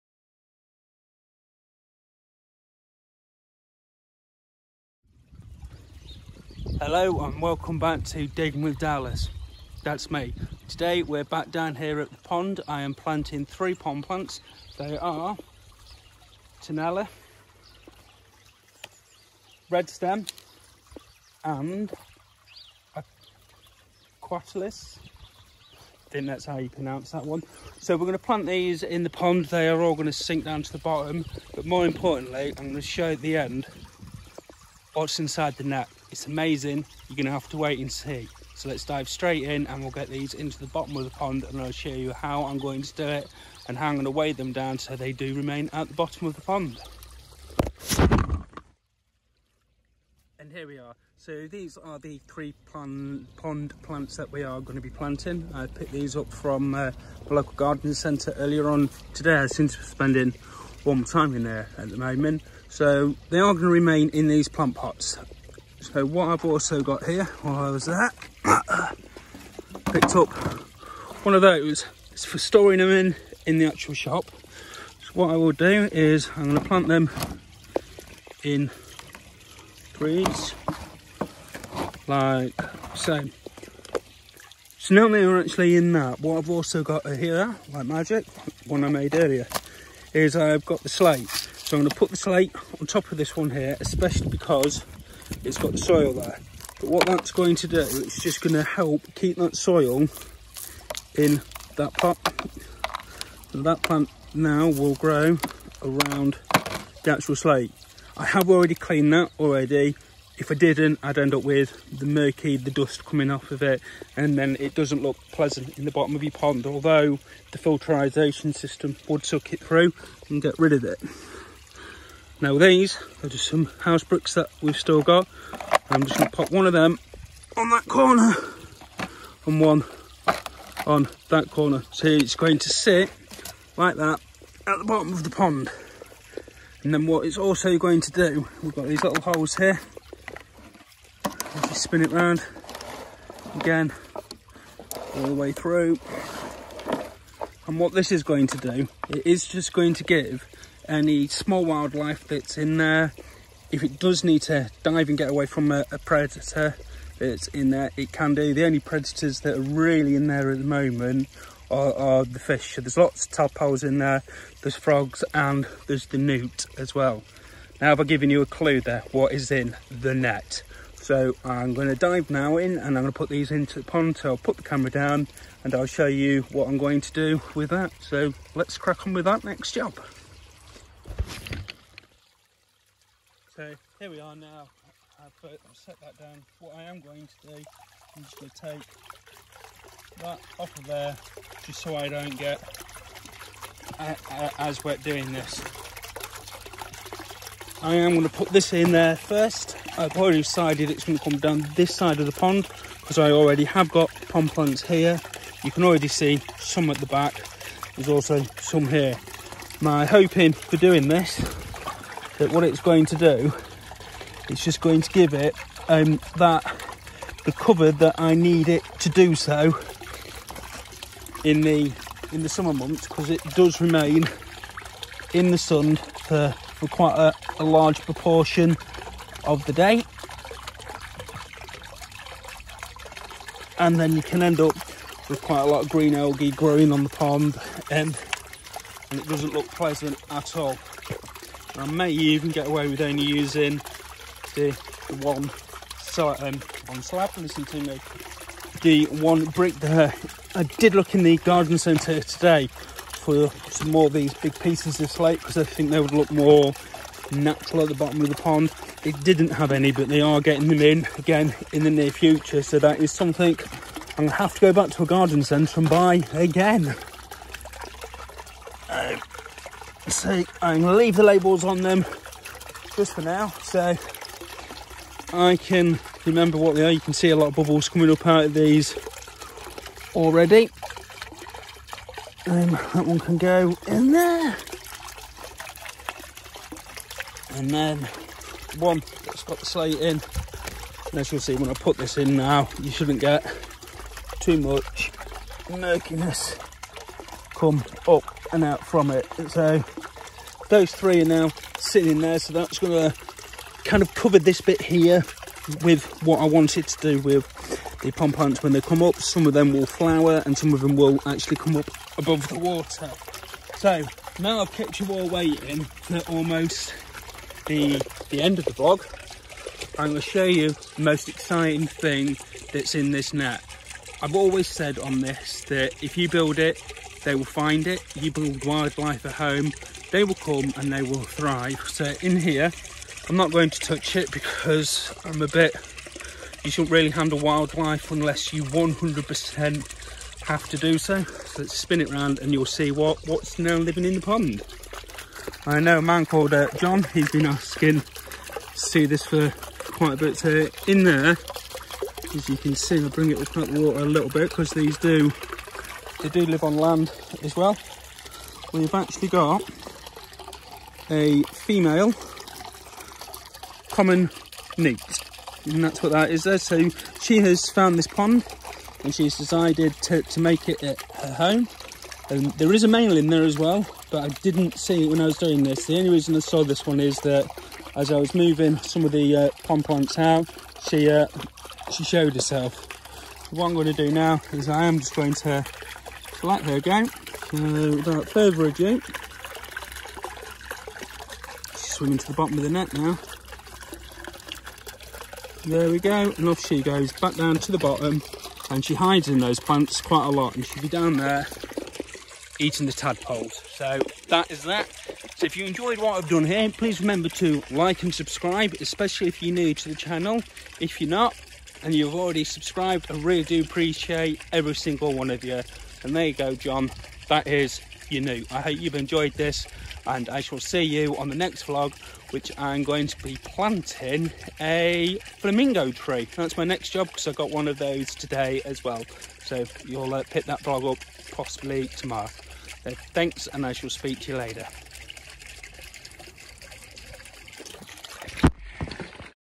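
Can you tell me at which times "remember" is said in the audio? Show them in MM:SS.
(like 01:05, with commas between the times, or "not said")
04:36, 06:47.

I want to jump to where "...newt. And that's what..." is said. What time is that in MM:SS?
06:04.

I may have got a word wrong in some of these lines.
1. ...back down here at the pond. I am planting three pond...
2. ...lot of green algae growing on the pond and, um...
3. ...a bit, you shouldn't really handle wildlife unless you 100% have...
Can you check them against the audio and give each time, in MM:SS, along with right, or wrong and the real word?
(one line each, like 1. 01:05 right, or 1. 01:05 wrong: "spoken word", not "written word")
1. 00:11 right
2. 03:55 right
3. 05:35 right.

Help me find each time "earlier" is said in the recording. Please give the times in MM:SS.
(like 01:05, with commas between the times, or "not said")
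00:58, 01:29.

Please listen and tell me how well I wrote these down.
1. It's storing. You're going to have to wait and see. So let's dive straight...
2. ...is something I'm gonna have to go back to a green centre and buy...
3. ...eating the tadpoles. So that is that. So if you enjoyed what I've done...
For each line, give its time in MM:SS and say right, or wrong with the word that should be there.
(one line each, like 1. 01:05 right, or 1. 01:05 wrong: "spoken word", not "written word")
1. 00:36 wrong: "amazing", not "storing"
2. 04:22 wrong: "garden", not "green"
3. 06:42 right.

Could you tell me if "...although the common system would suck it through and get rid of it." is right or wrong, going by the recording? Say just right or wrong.
wrong.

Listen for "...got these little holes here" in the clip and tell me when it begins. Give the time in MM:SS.
02:18.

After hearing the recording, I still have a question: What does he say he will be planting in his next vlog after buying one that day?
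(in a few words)
A flamingo tree.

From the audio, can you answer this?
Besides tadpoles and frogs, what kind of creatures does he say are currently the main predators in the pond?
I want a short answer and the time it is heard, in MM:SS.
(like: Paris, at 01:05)
Fish, at 02:42.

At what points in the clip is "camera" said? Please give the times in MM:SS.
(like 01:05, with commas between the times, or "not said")
02:54.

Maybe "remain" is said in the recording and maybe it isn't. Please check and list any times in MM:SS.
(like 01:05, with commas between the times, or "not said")
00:45, 01:03, 03:43.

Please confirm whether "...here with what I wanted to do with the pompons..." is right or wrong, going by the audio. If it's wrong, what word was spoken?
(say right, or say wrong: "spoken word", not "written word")
right.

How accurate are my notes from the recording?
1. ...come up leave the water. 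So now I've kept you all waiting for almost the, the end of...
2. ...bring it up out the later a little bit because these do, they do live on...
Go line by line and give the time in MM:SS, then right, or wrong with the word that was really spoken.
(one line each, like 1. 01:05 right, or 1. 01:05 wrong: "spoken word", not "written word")
1. 05:11 wrong: "above", not "leave"
2. 05:53 wrong: "water", not "later".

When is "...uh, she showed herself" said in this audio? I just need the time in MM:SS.
06:21.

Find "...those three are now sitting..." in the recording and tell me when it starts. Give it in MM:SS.
05:00.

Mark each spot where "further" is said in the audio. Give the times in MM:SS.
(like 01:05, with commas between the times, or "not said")
06:28.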